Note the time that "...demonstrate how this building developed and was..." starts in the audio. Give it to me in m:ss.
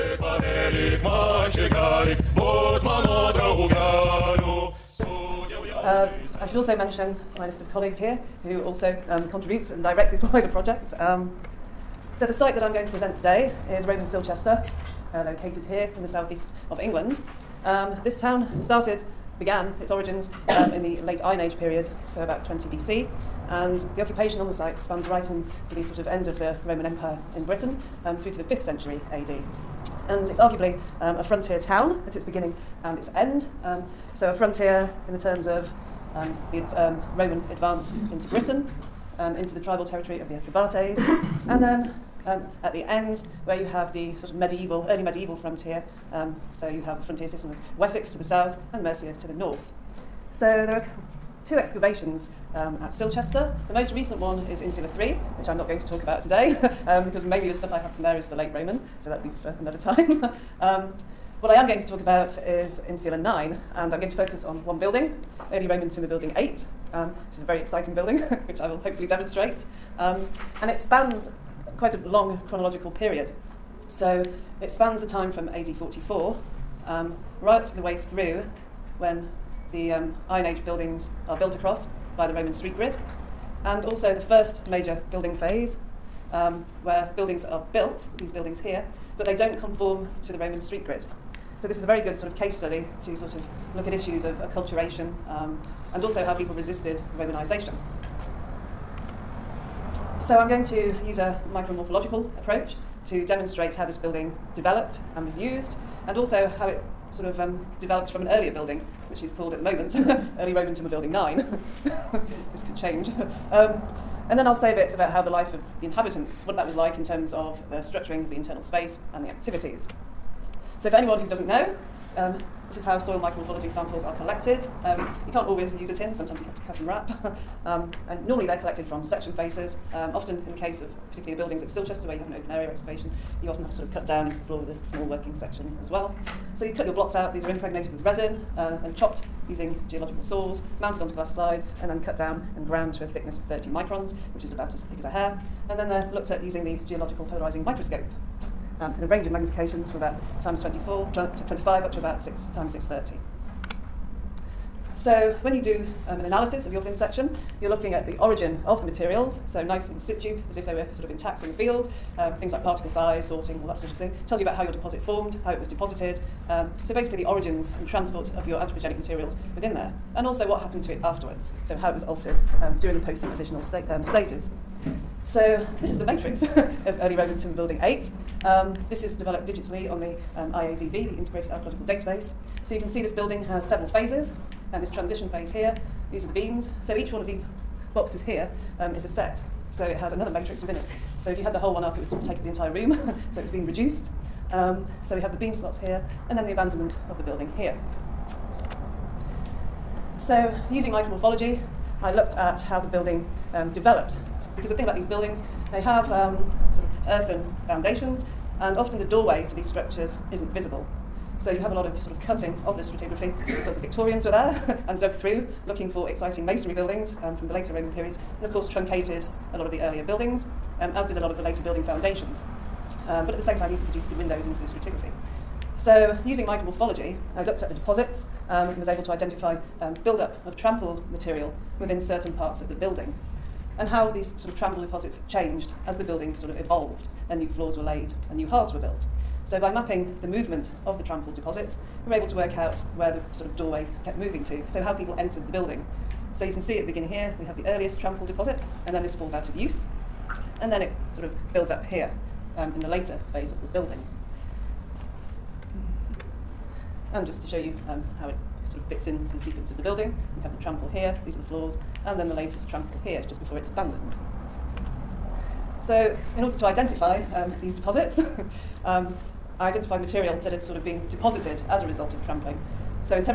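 1:43.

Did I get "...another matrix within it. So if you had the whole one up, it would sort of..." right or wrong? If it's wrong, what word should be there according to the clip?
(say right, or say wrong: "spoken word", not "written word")
right.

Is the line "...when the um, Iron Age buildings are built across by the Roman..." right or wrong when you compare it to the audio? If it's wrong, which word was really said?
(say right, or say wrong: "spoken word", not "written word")
right.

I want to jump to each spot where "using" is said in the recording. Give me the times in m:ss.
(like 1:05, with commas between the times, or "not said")
2:19, 2:26, 3:20, 3:46.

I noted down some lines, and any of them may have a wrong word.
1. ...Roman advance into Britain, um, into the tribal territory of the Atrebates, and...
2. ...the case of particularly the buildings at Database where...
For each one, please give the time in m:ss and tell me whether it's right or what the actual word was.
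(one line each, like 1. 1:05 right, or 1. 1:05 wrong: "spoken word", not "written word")
1. 0:37 right
2. 2:10 wrong: "Silchester", not "Database".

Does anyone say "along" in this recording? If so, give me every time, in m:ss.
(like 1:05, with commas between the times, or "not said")
not said.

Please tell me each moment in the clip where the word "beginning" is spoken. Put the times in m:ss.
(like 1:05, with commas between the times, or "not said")
0:32, 4:06.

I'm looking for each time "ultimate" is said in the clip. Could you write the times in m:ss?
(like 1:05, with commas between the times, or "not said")
not said.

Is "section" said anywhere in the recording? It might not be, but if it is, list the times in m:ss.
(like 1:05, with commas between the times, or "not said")
2:09, 2:15, 2:36.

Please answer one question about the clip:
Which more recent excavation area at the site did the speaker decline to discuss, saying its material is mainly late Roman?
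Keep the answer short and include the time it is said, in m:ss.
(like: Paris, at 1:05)
Insula 3, at 0:54.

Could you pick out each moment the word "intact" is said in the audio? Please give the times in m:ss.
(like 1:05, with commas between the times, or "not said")
2:41.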